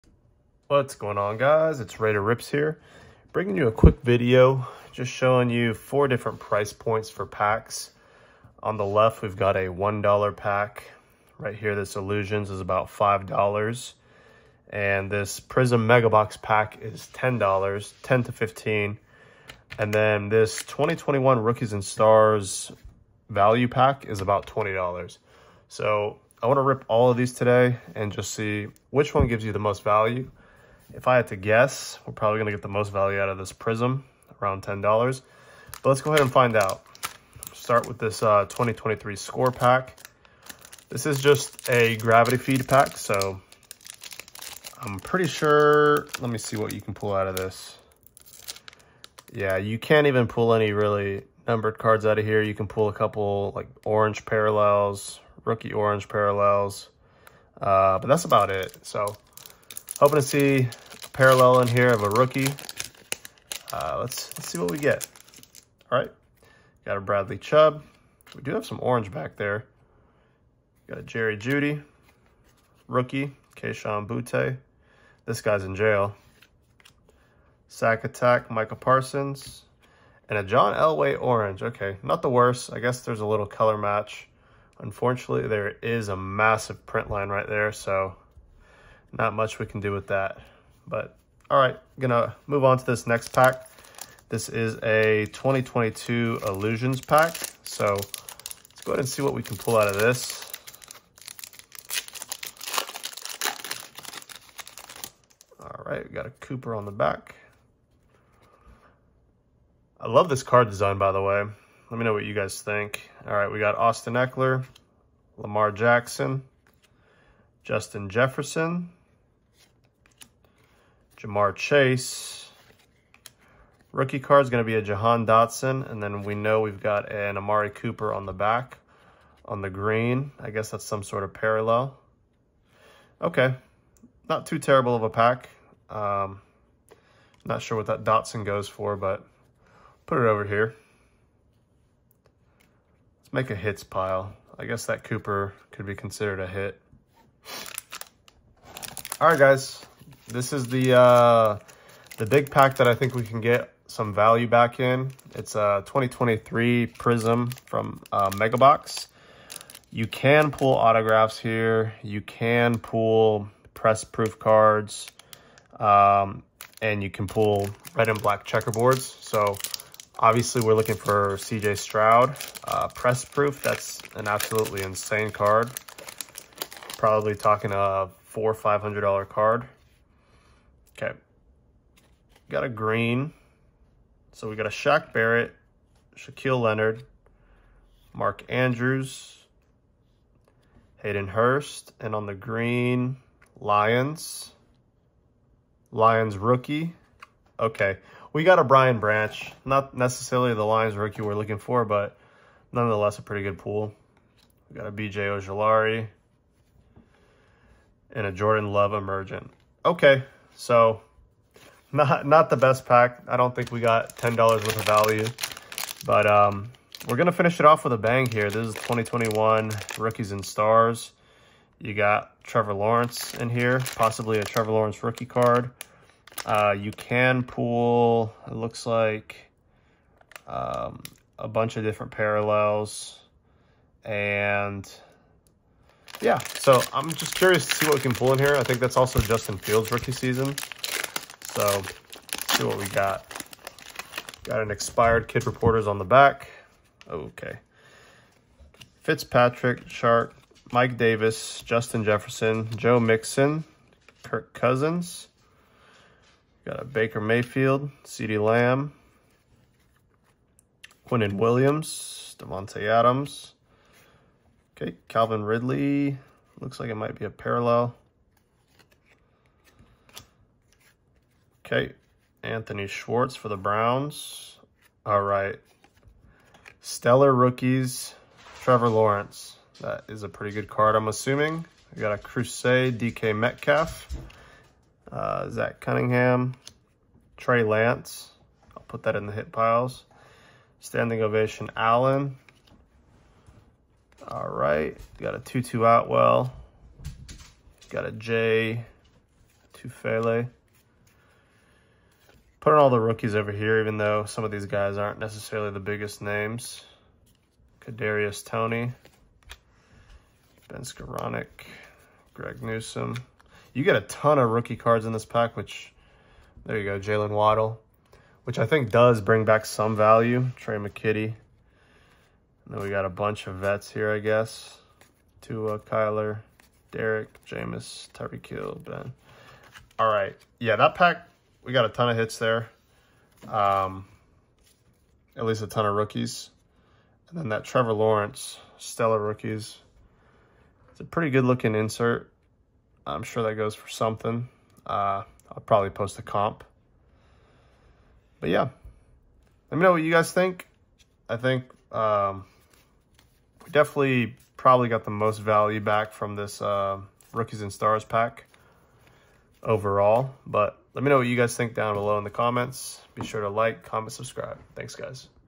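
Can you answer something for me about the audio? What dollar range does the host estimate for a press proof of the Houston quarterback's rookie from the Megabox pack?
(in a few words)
$400 to $500.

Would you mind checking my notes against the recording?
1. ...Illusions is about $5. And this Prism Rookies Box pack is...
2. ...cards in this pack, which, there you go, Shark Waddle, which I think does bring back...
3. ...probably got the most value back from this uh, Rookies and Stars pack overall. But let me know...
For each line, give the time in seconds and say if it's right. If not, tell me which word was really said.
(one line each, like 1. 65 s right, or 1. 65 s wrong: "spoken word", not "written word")
1. 11 s wrong: "Mega", not "Rookies"
2. 314 s wrong: "Jaylen", not "Shark"
3. 354 s right.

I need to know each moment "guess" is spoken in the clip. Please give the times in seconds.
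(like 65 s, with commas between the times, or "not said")
31 s, 82 s, 130 s, 144 s, 324 s.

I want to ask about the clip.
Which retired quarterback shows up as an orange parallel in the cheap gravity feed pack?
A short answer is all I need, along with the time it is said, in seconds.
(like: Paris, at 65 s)
John Elway, at 80 s.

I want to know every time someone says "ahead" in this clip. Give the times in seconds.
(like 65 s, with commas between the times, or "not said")
36 s, 98 s.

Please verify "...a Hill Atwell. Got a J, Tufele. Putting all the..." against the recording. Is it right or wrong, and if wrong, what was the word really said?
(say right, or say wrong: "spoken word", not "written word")
wrong: "Tutu", not "Hill".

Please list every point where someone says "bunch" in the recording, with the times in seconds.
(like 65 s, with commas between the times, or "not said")
231 s, 323 s.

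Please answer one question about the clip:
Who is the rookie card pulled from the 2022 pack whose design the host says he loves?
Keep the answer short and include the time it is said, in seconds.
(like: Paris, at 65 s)
Jahan Dotson, at 124 s.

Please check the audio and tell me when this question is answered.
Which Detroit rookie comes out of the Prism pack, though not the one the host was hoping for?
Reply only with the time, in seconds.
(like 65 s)
198 s.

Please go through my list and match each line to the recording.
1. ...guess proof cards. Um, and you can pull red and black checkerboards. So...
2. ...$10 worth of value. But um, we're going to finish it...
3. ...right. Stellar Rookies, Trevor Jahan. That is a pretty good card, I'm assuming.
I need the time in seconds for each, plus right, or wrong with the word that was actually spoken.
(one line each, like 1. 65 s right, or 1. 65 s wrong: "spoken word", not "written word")
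1. 163 s wrong: "press", not "guess"
2. 214 s right
3. 275 s wrong: "Lawrence", not "Jahan".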